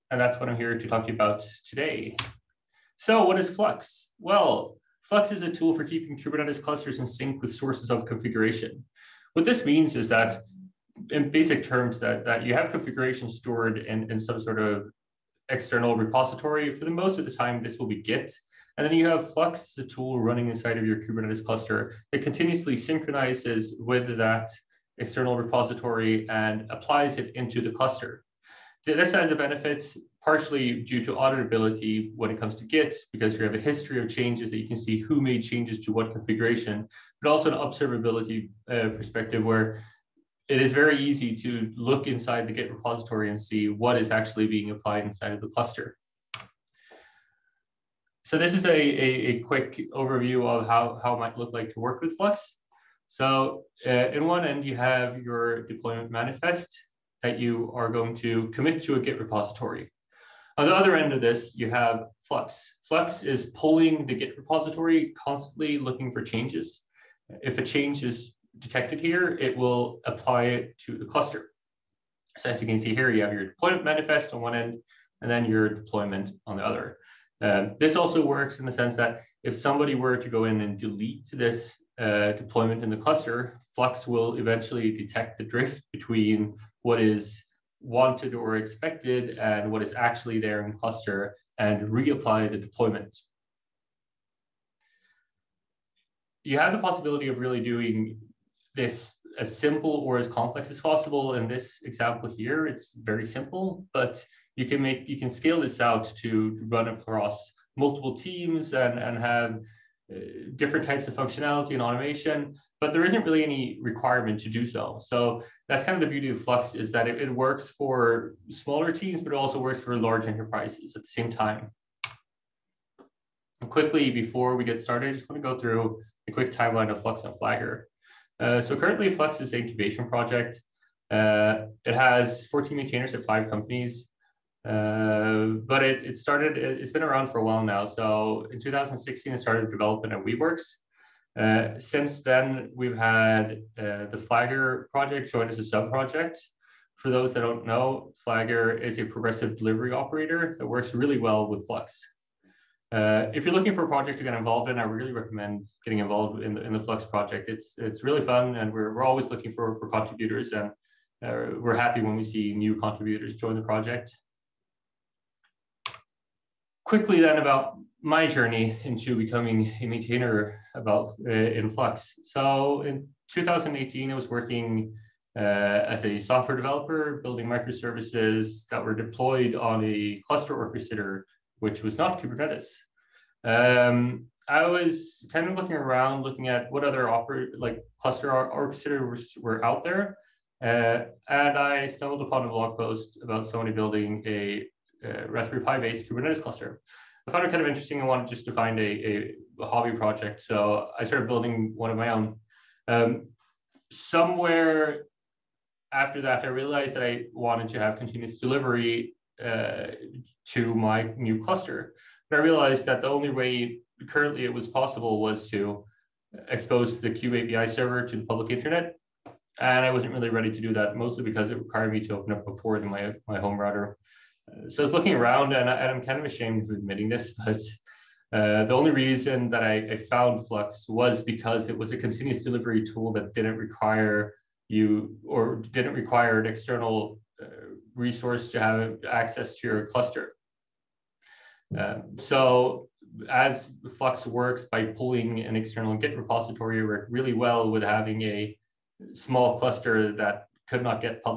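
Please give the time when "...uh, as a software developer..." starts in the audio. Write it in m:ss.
2:55.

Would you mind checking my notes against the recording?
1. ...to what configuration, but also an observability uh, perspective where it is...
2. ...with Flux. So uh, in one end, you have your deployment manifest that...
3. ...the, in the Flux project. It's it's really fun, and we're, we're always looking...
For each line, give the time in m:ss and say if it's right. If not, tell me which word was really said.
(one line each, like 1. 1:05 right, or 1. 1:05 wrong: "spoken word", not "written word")
1. 0:35 right
2. 0:52 right
3. 2:36 right.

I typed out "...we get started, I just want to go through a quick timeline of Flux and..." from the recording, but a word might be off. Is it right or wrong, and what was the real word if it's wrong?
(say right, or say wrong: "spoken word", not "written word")
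right.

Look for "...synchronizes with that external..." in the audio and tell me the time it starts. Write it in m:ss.
0:22.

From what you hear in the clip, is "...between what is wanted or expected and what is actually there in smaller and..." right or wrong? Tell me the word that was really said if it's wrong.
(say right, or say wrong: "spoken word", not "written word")
wrong: "cluster", not "smaller".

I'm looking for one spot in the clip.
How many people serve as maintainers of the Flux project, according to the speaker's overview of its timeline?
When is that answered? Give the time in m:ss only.
2:12.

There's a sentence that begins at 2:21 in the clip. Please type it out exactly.
Uh, since then, we've had uh, the Flagger project join as a sub-project.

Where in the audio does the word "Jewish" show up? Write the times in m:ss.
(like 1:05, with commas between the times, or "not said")
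not said.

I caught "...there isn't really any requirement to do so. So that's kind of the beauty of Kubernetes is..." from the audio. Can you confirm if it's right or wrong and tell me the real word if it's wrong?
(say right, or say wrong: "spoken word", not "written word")
wrong: "Flux", not "Kubernetes".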